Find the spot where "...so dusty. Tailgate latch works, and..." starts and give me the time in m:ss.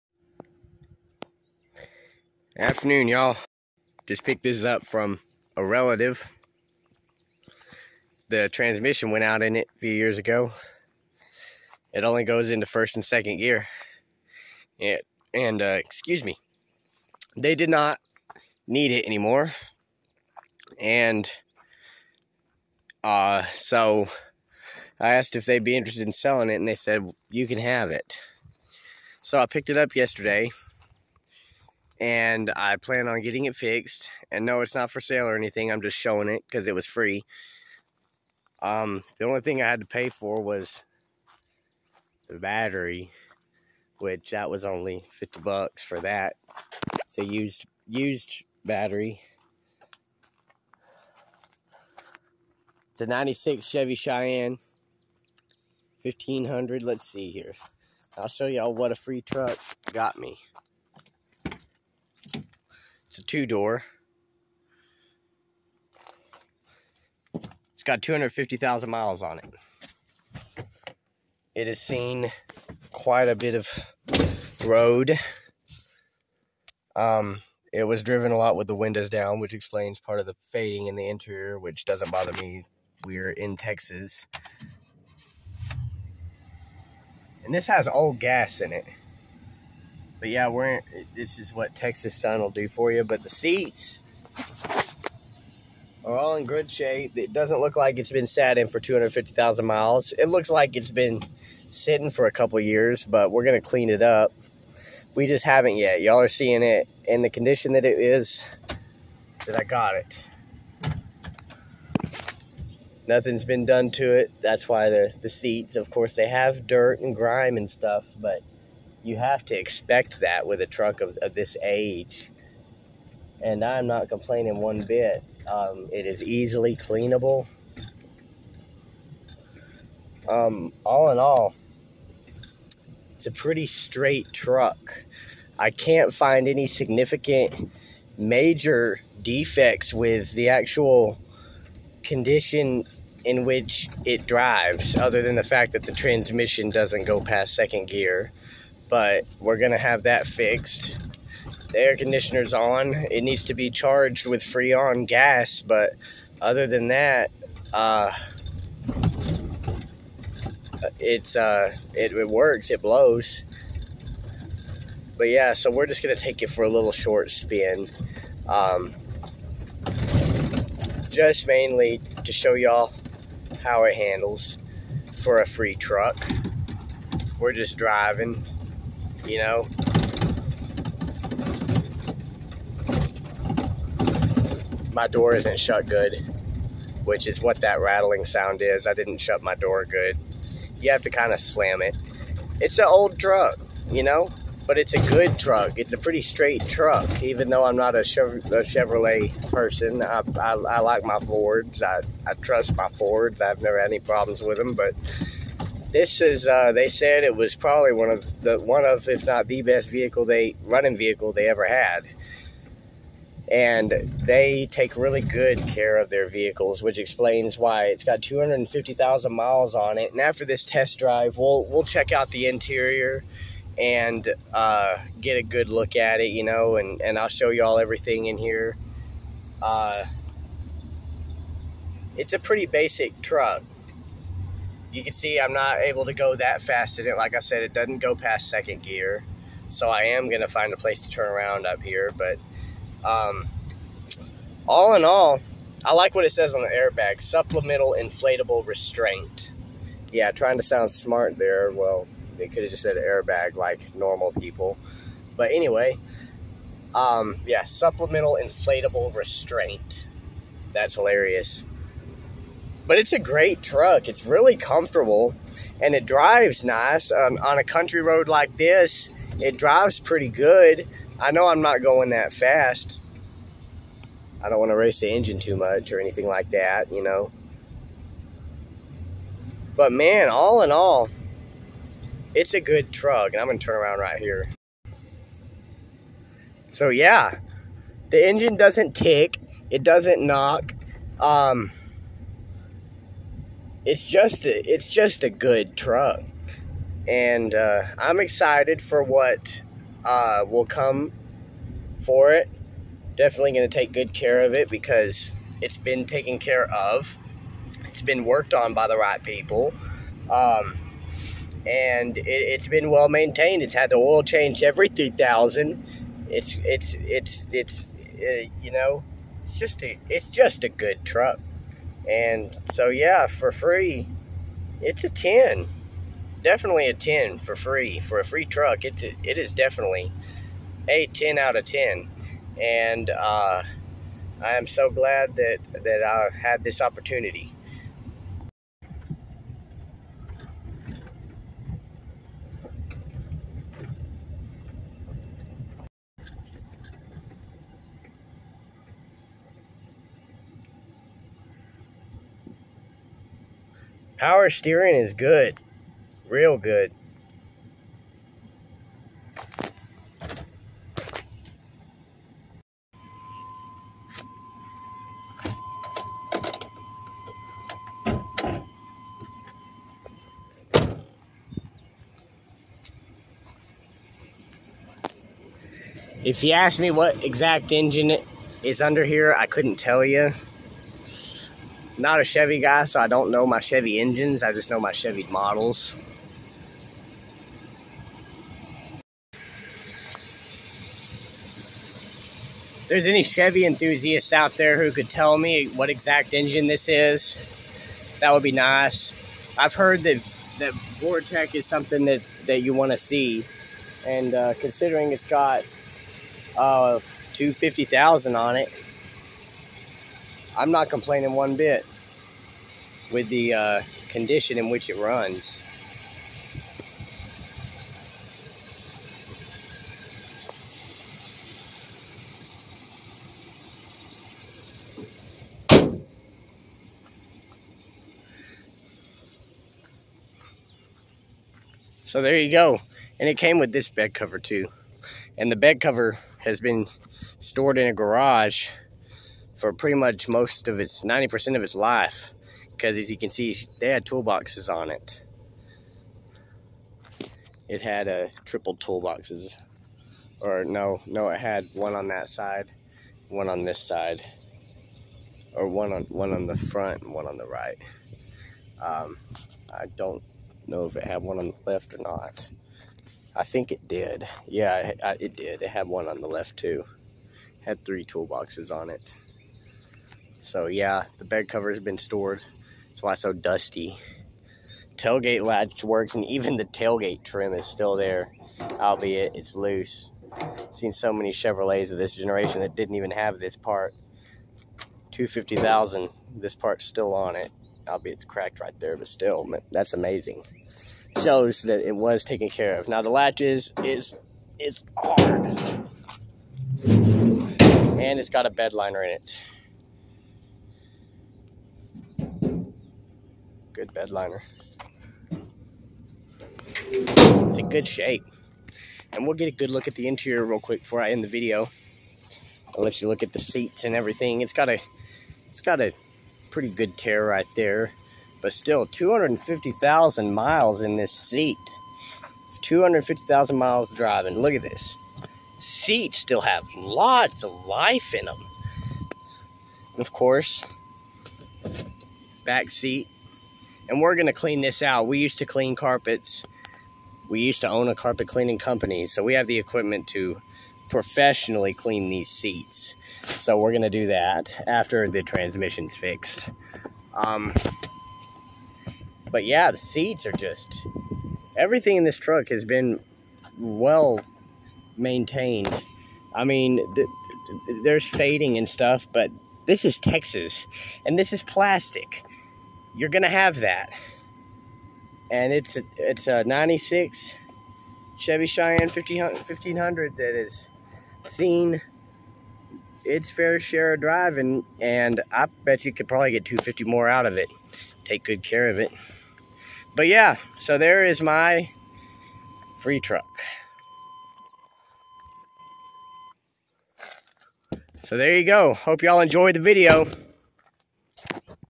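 7:53.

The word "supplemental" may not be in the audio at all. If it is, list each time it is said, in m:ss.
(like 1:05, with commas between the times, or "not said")
4:07, 4:17.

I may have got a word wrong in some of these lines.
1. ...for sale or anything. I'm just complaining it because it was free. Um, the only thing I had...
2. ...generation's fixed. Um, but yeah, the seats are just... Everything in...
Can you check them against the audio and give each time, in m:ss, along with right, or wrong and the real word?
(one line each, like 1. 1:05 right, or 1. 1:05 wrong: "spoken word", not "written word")
1. 0:34 wrong: "showing", not "complaining"
2. 9:05 wrong: "transmission", not "generation".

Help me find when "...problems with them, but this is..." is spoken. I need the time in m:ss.
3:23.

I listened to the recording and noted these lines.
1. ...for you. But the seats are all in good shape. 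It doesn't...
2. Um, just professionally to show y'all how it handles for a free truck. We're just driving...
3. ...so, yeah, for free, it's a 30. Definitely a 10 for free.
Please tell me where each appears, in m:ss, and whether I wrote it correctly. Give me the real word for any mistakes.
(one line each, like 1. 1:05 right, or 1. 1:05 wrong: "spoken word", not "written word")
1. 1:32 right
2. 2:48 wrong: "mainly", not "professionally"
3. 5:22 wrong: "10", not "30".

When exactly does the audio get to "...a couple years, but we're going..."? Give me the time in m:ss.
1:42.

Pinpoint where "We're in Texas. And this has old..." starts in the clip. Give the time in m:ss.
1:23.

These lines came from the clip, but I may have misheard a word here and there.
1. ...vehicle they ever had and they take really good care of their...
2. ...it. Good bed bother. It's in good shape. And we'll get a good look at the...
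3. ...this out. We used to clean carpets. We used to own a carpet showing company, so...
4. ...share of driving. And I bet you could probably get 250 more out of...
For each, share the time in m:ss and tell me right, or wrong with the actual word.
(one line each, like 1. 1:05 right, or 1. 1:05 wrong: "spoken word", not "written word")
1. 3:30 right
2. 8:19 wrong: "liner", not "bother"
3. 8:54 wrong: "cleaning", not "showing"
4. 9:33 right.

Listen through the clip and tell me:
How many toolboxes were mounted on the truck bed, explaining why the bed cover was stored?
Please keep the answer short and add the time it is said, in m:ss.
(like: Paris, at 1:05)
3, at 7:47.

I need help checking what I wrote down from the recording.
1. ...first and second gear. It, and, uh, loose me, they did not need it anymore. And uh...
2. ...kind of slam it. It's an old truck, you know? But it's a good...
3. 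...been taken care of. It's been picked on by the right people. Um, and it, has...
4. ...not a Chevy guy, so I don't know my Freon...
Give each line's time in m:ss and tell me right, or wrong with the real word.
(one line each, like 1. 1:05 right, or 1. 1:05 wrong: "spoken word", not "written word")
1. 0:12 wrong: "excuse", not "loose"
2. 3:11 right
3. 5:05 wrong: "worked", not "picked"
4. 6:22 wrong: "Chevy", not "Freon".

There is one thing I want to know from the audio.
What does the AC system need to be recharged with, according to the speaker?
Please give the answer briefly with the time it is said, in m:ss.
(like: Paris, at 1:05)
Freon gas, at 2:34.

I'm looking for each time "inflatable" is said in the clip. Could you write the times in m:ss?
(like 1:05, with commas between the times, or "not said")
4:07, 4:18.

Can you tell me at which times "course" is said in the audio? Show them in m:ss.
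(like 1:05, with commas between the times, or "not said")
1:55, 8:50.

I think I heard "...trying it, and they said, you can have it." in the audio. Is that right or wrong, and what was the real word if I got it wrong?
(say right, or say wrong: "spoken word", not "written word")
wrong: "selling", not "trying".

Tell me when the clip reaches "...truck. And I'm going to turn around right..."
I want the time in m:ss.
4:42.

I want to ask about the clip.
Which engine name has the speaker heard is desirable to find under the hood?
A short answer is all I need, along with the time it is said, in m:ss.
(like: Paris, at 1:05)
Vortec, at 6:40.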